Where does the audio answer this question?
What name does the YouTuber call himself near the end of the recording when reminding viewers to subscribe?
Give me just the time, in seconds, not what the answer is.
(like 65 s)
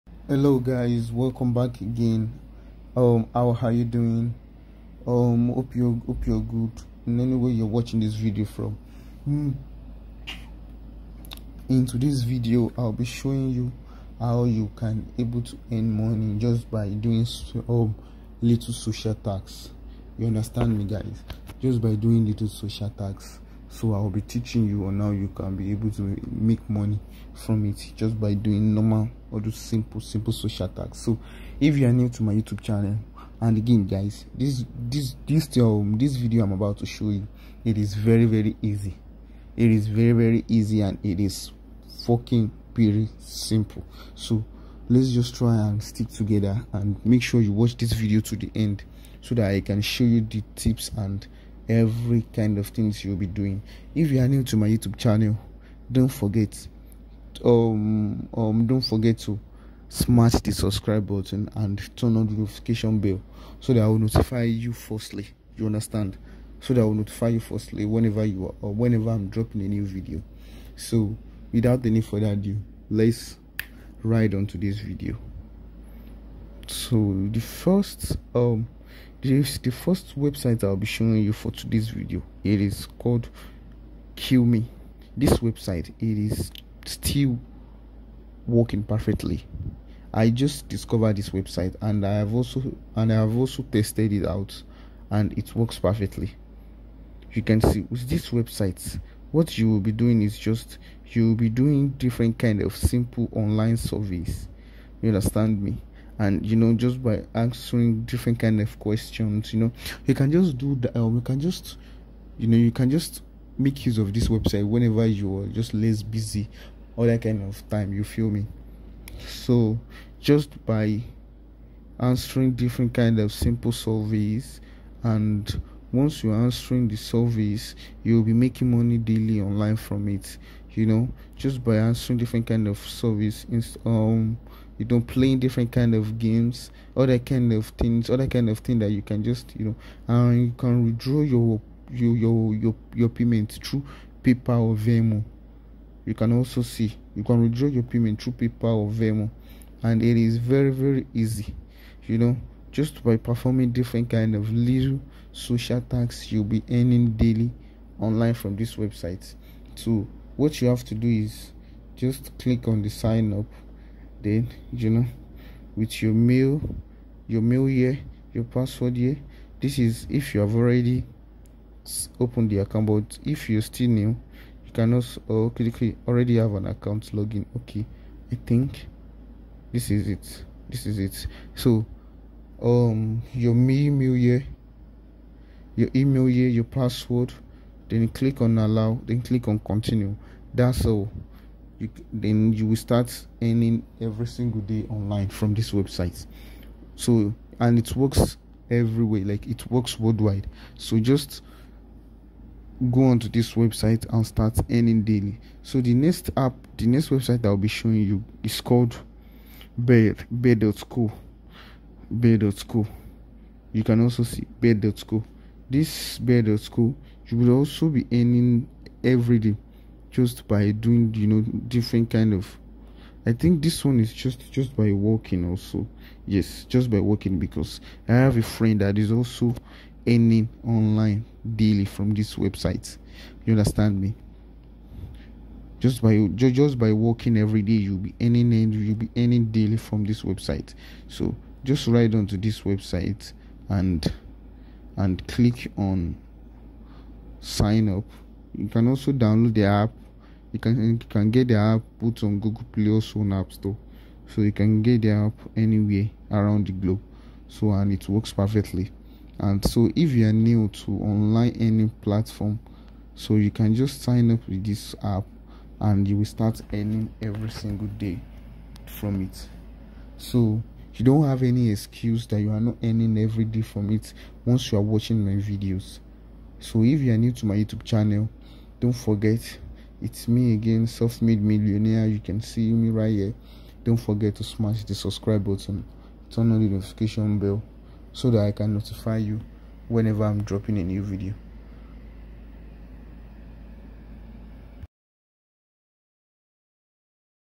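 280 s.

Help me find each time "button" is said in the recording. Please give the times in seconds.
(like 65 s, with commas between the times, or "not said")
61 s, 285 s.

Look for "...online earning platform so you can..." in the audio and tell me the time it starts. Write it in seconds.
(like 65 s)
261 s.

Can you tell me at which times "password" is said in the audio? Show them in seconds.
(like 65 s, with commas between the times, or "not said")
168 s, 186 s.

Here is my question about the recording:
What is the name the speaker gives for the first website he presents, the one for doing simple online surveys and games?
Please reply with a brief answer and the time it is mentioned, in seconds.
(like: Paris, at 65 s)
Kill Me, at 84 s.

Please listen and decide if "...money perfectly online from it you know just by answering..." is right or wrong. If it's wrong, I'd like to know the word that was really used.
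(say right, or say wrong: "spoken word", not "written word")
wrong: "daily", not "perfectly".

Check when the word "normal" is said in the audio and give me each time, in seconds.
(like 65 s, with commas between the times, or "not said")
28 s.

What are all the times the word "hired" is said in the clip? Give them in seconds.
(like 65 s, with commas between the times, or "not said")
not said.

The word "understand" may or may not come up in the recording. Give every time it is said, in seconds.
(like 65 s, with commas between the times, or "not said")
20 s, 65 s, 105 s, 233 s.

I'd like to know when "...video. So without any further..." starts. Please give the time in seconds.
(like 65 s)
69 s.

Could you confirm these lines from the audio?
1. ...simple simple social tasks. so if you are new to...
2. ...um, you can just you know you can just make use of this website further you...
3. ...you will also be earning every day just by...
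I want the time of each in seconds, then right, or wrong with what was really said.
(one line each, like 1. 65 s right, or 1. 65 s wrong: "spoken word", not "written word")
1. 29 s wrong: "attacks", not "tasks"
2. 110 s wrong: "whenever", not "further"
3. 217 s right.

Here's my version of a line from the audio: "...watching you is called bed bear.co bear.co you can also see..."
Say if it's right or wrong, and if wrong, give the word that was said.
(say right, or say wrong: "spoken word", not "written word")
wrong: "showing", not "watching".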